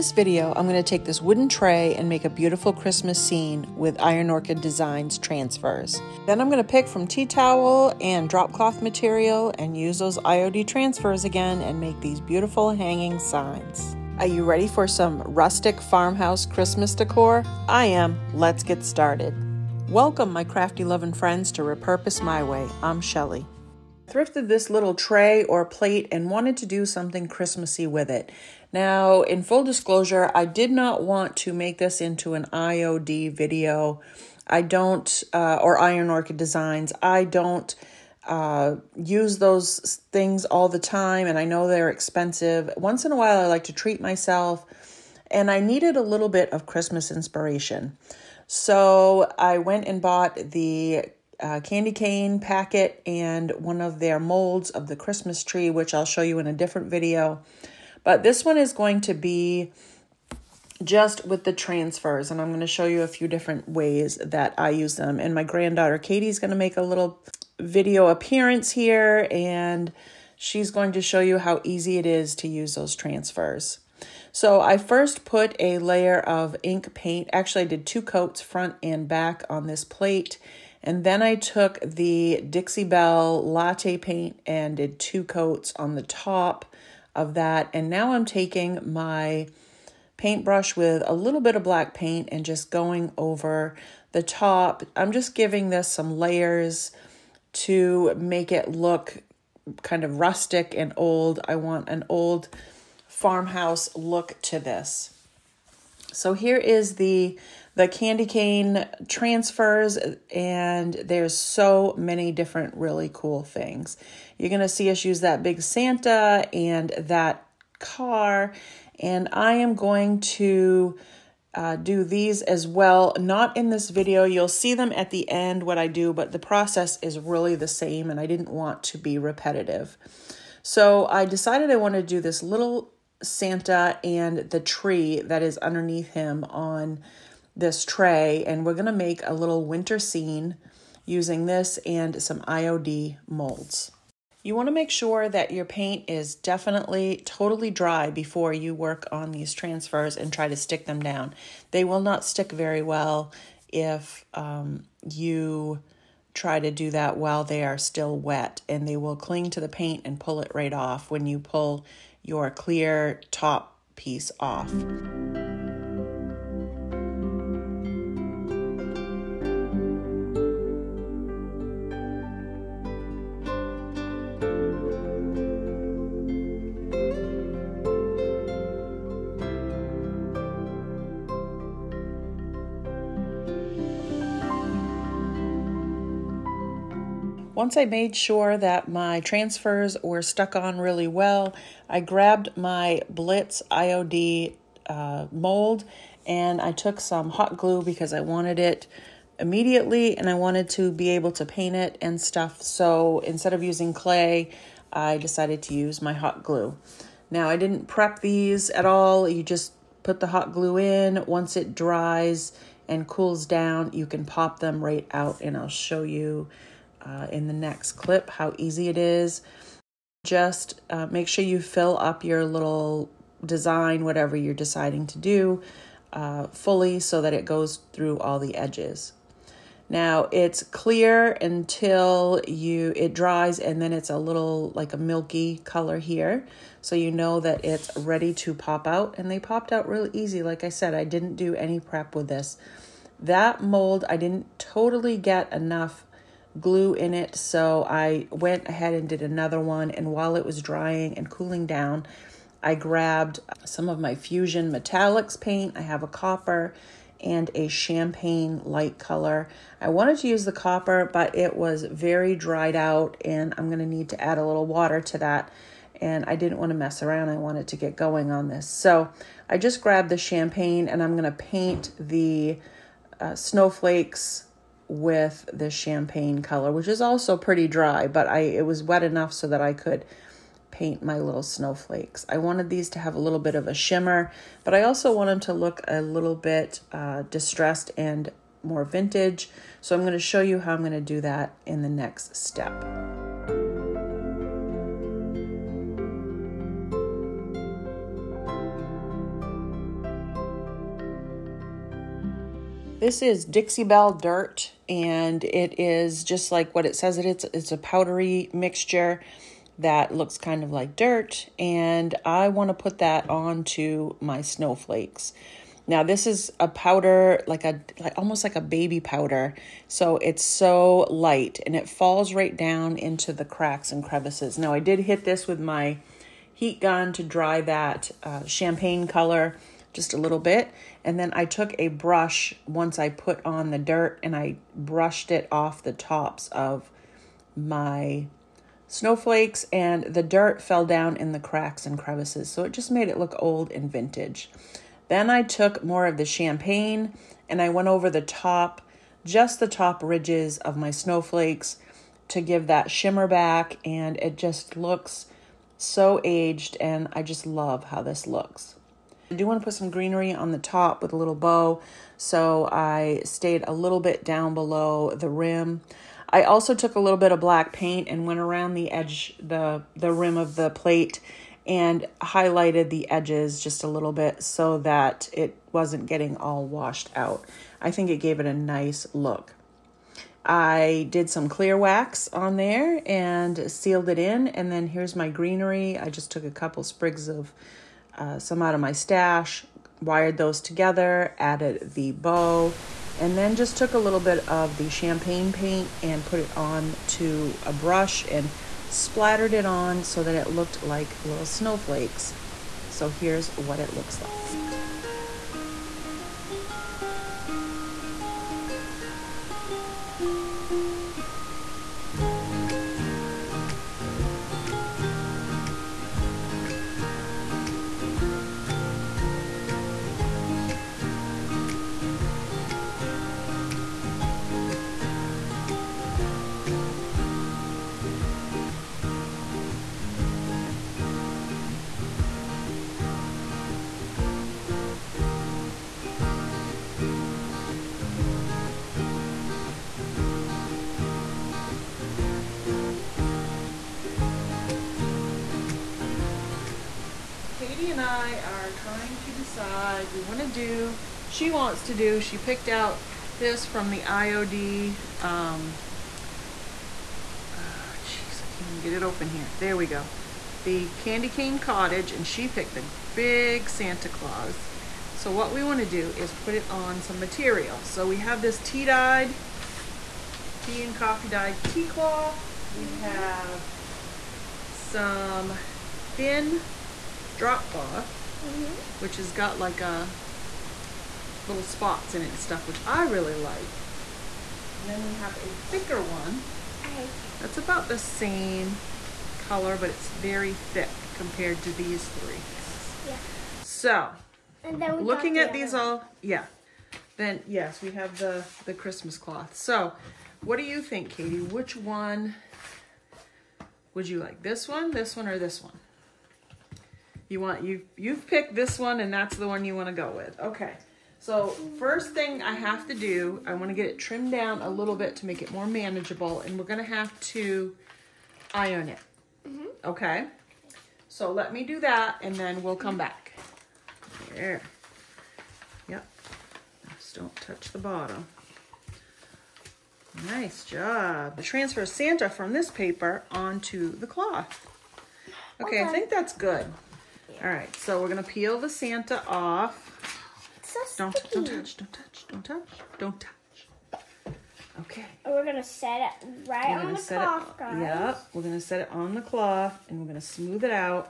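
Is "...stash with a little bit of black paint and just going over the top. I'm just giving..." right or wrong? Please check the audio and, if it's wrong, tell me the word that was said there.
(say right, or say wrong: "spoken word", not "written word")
wrong: "paintbrush", not "stash".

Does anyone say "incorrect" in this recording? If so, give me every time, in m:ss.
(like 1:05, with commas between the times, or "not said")
not said.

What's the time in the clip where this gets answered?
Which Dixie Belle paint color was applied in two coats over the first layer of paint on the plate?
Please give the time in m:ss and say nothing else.
1:23.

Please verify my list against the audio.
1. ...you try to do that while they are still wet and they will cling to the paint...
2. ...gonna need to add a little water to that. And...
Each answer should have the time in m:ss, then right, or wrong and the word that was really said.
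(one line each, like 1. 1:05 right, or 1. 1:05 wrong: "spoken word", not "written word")
1. 2:35 right
2. 4:23 right.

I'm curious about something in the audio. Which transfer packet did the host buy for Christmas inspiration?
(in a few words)
Candy cane packet.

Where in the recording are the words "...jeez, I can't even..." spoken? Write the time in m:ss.
7:38.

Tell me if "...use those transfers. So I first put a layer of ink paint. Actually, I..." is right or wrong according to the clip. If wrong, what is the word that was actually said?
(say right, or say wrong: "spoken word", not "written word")
right.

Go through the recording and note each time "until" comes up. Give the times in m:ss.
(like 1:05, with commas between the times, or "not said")
3:51.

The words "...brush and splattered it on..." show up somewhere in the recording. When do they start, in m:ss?
6:37.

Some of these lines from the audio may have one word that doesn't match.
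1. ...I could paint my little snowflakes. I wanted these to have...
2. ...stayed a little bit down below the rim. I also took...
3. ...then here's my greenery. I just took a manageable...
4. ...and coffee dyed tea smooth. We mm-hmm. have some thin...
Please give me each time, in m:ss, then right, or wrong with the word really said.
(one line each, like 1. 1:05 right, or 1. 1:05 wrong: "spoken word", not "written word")
1. 4:39 right
2. 6:03 right
3. 6:24 wrong: "couple", not "manageable"
4. 7:50 wrong: "cloth", not "smooth".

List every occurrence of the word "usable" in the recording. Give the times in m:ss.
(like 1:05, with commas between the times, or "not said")
not said.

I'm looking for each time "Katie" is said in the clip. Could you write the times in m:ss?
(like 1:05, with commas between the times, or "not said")
1:05, 8:21.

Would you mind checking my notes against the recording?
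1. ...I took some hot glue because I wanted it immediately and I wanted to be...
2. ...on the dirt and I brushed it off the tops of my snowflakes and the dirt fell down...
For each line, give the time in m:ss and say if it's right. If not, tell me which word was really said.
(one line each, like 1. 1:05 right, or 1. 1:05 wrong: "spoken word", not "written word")
1. 3:16 right
2. 5:33 right.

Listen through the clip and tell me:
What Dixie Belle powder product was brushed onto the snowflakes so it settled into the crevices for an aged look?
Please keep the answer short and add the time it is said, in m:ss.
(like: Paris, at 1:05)
Dixie Belle Dirt, at 5:03.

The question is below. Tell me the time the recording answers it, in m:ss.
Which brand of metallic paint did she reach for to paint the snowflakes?
4:14.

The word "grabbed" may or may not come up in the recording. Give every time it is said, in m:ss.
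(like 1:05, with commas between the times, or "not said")
3:11, 4:12, 4:29.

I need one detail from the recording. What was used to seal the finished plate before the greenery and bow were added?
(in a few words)
Clear wax.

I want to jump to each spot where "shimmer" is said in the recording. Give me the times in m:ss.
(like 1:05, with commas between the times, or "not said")
4:43, 5:52.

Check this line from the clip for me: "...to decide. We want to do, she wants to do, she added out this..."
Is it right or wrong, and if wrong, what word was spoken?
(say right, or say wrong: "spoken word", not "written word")
wrong: "picked", not "added".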